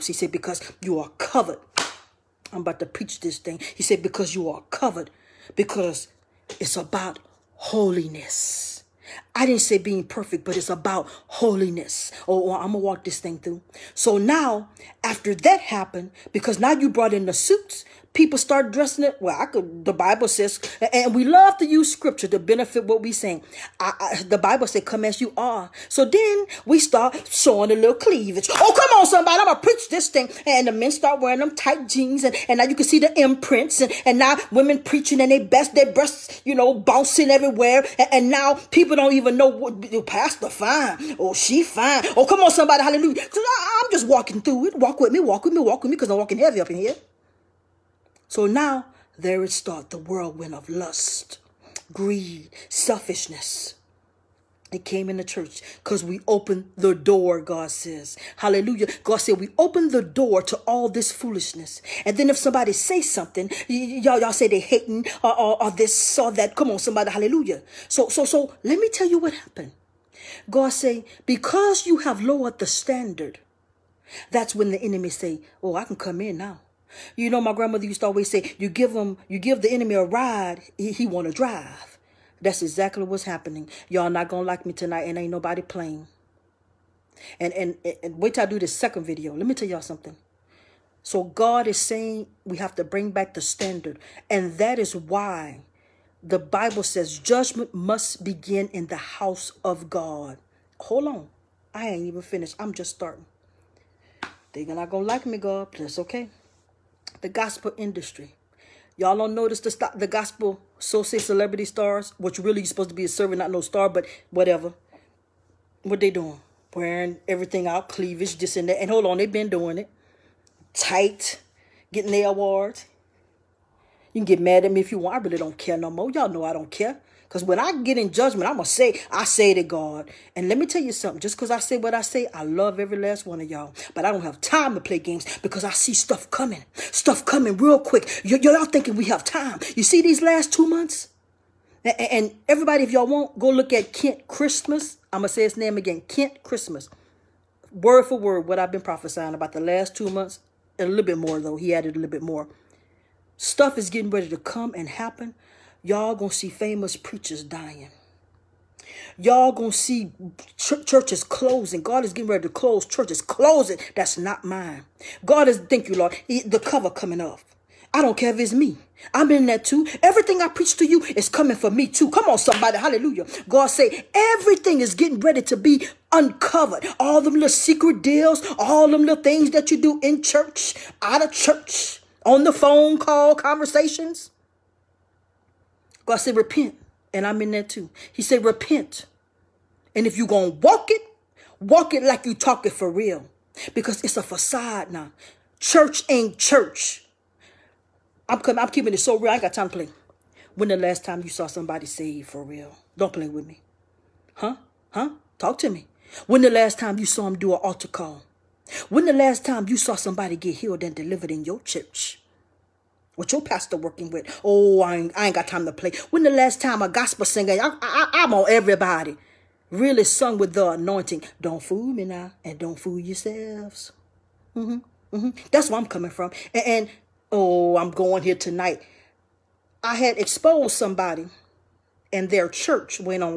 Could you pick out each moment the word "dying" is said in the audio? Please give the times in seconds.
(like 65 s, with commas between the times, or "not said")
157 s.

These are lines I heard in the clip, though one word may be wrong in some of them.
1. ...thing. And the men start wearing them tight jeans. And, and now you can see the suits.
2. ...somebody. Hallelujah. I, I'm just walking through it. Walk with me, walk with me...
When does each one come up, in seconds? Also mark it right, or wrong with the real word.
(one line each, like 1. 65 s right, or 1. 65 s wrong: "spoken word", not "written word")
1. 30 s wrong: "imprints", not "suits"
2. 42 s right.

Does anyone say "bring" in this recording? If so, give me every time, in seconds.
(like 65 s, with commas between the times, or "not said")
92 s.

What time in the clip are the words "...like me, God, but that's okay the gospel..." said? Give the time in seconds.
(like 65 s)
105 s.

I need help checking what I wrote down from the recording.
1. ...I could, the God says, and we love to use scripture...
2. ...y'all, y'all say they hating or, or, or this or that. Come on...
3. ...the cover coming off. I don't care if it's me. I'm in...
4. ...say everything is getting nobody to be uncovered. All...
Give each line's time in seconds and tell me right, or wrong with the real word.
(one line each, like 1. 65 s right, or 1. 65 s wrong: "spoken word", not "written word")
1. 19 s wrong: "Bible", not "God"
2. 63 s right
3. 166 s right
4. 173 s wrong: "ready", not "nobody".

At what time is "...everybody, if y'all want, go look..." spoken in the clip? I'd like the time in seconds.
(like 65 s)
142 s.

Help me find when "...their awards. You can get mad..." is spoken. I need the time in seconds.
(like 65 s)
122 s.